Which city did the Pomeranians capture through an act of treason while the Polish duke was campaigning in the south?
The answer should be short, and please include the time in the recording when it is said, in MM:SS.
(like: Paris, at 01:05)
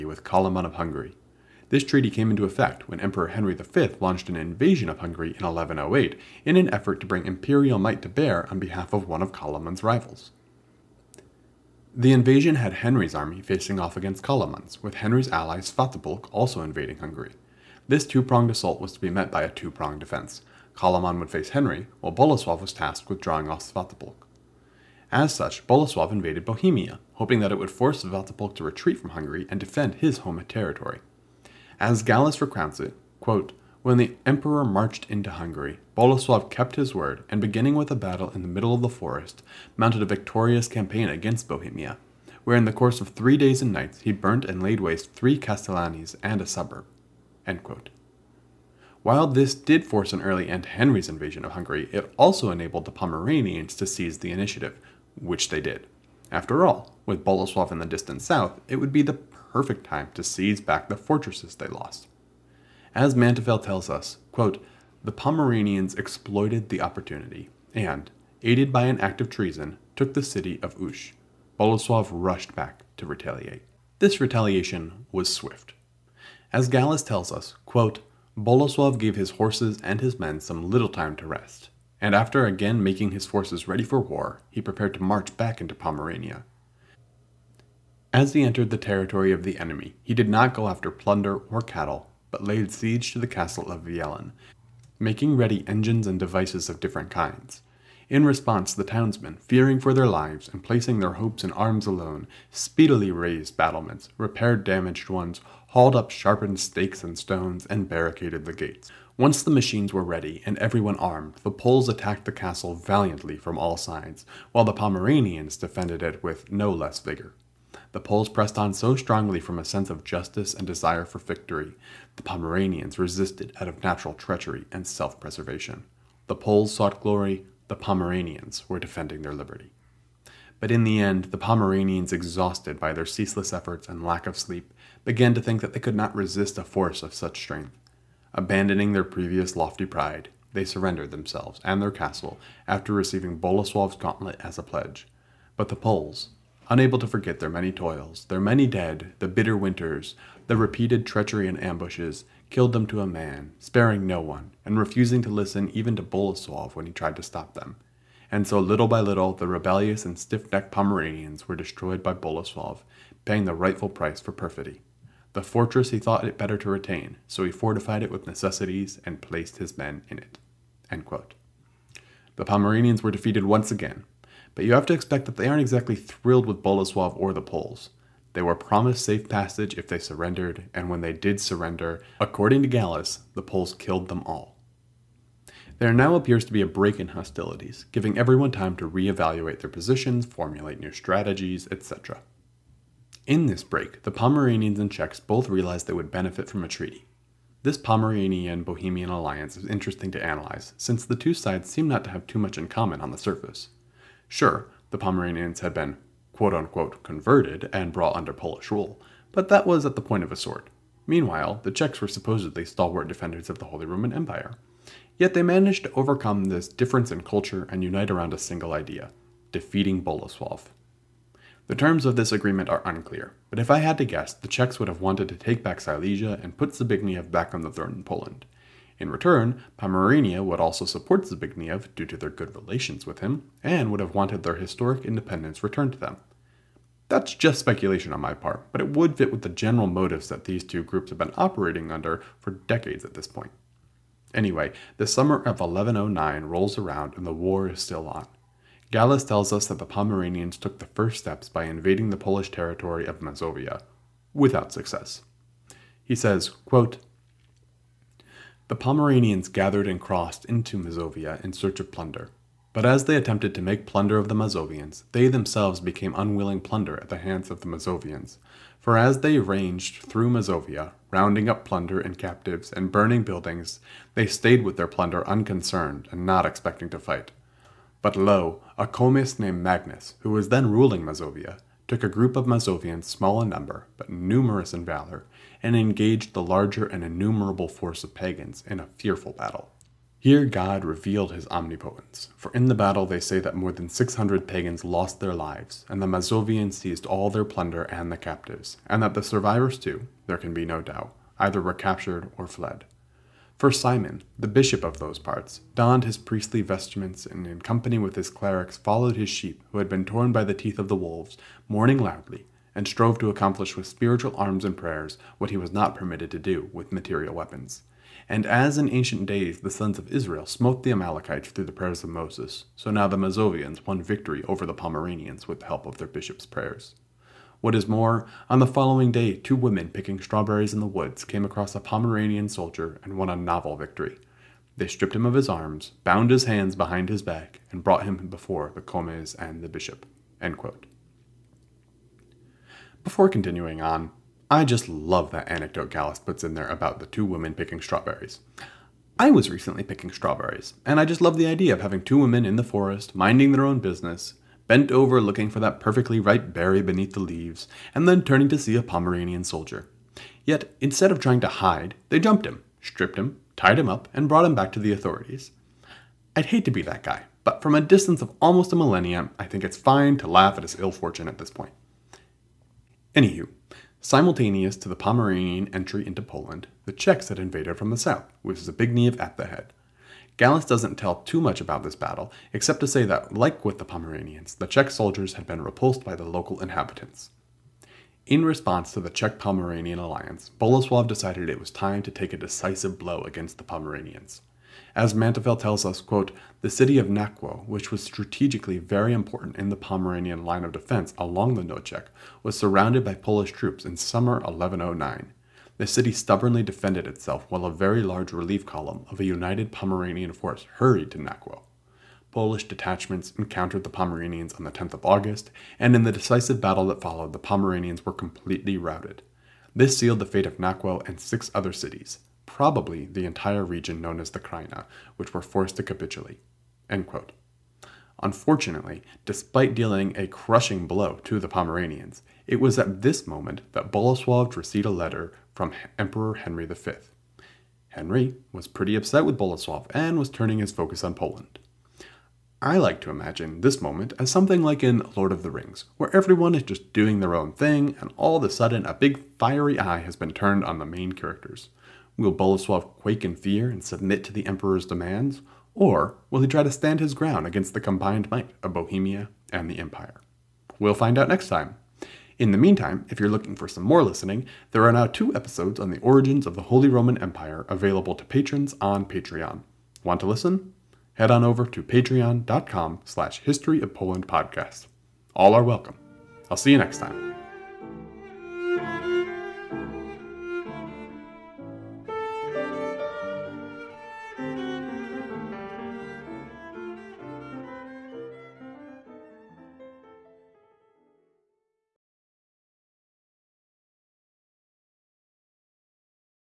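Ush, at 01:10.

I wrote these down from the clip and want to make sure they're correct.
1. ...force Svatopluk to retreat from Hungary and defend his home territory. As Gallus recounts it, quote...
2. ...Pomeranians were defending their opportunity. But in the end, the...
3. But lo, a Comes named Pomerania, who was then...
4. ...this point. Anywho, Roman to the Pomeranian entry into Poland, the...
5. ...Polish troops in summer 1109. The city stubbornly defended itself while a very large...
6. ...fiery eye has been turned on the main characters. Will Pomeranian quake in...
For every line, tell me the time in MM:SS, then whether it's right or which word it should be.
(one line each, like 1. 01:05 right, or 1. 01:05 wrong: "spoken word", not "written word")
1. 00:27 right
2. 02:07 wrong: "liberty", not "opportunity"
3. 04:38 wrong: "Magnus", not "Pomerania"
4. 06:11 wrong: "Simultaneous", not "Roman"
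5. 06:43 right
6. 07:29 wrong: "Boleslav", not "Pomeranian".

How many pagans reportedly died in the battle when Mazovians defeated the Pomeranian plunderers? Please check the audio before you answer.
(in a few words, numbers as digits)
600.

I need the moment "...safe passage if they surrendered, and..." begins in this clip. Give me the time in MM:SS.
02:59.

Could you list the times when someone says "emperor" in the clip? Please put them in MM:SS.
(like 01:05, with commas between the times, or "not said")
00:02, 00:34, 07:15, 07:34.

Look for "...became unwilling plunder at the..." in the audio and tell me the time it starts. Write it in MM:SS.
04:25.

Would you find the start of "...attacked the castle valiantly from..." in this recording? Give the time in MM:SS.
01:51.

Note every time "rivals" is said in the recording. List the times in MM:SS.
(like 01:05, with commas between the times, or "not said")
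00:09.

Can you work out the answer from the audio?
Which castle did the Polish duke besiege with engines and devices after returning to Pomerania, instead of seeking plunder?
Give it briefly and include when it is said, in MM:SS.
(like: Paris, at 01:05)
Wieleń, at 01:33.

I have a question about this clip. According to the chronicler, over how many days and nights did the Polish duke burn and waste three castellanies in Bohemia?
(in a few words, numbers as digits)
3.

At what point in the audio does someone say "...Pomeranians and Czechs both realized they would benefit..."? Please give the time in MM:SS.
03:14.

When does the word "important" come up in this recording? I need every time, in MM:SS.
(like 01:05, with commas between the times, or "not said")
06:39.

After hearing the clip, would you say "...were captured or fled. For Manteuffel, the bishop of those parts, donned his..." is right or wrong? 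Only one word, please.
wrong.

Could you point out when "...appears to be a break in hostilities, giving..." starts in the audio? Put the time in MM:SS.
03:06.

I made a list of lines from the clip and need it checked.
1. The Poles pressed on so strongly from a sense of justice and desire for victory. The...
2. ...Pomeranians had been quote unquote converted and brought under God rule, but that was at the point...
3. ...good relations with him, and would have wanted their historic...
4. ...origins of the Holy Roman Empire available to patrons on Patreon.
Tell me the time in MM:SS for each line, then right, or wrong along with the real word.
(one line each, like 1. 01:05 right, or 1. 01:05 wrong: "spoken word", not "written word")
1. 01:57 right
2. 03:24 wrong: "Polish", not "God"
3. 03:52 right
4. 07:45 right.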